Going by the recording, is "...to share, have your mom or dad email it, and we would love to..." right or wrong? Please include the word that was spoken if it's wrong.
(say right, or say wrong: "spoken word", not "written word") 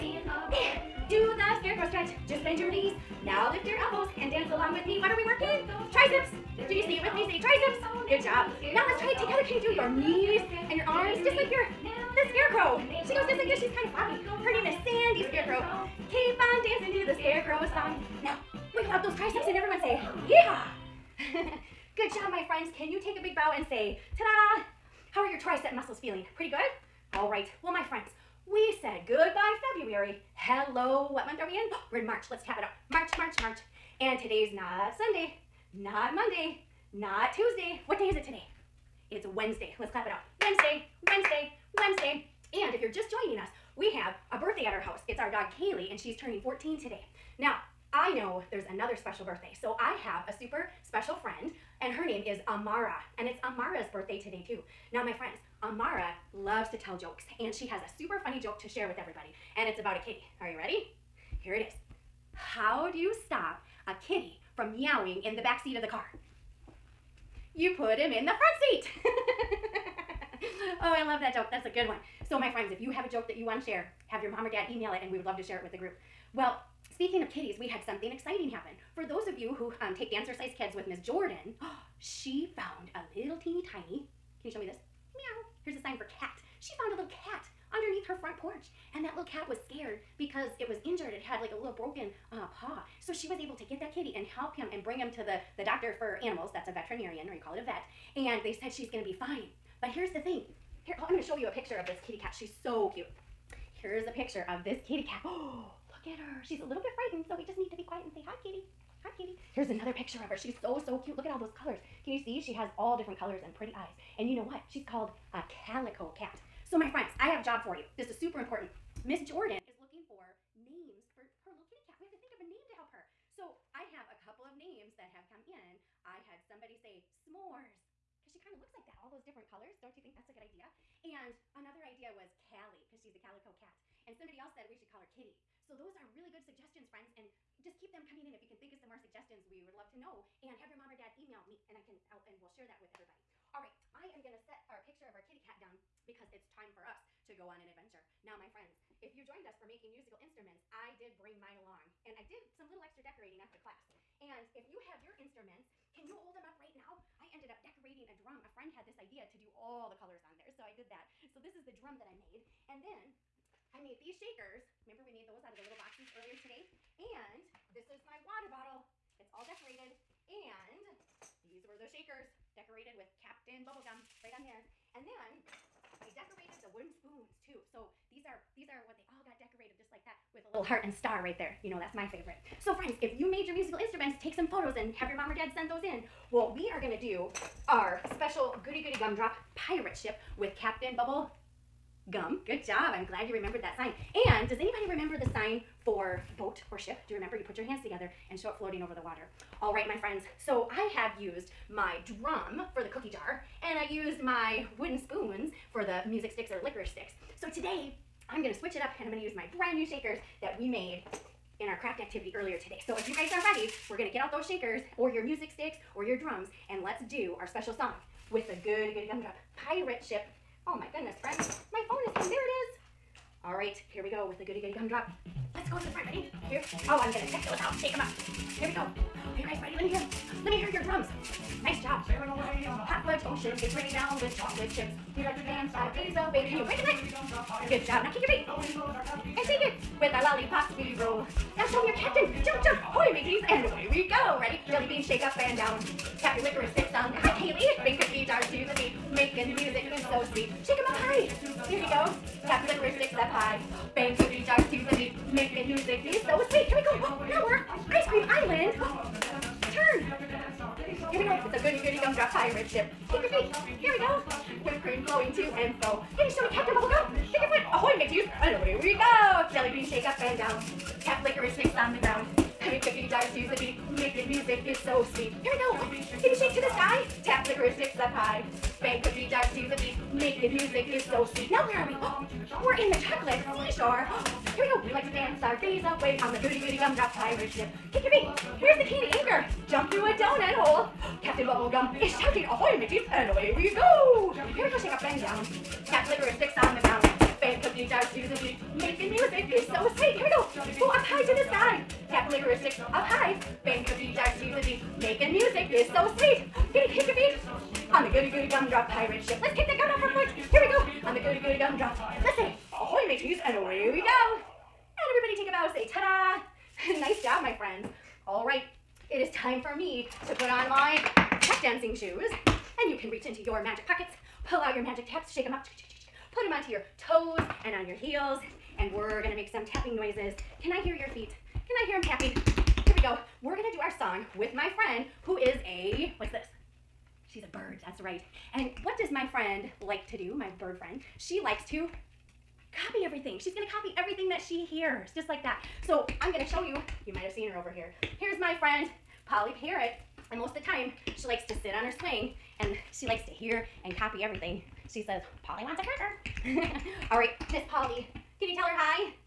right.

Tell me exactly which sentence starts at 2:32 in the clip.
And I did some little extra decorating after class.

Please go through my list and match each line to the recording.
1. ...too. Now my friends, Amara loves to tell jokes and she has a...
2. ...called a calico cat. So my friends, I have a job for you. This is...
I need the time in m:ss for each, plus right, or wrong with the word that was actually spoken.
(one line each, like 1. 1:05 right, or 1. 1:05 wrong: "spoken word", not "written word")
1. 0:54 right
2. 1:54 right.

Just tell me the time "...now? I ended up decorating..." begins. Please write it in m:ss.
2:36.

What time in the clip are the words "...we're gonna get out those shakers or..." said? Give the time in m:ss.
3:33.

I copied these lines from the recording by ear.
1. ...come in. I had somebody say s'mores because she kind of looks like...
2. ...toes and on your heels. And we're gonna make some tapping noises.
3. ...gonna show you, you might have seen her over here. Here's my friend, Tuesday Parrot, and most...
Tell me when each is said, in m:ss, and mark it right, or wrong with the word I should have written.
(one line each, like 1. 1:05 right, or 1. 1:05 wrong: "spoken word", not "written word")
1. 2:05 right
2. 5:27 right
3. 5:46 wrong: "Polly", not "Tuesday".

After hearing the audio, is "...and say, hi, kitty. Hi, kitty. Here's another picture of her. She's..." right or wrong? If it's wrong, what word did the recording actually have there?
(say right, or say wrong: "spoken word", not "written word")
right.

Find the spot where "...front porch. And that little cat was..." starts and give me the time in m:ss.
1:28.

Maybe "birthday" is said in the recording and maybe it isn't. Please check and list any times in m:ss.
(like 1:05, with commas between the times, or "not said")
0:44, 0:49, 0:53.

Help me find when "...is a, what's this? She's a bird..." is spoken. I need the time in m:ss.
5:35.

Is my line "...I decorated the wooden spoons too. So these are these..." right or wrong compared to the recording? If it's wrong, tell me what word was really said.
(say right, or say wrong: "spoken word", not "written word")
right.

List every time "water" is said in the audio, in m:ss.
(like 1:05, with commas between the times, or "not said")
2:48, 3:19.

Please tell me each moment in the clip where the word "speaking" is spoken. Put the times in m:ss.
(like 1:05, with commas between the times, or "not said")
1:16.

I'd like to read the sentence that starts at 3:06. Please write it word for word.
Well, we are gonna do our special Goody Goody Gumdrop pirate ship with Captain Bubble Gum.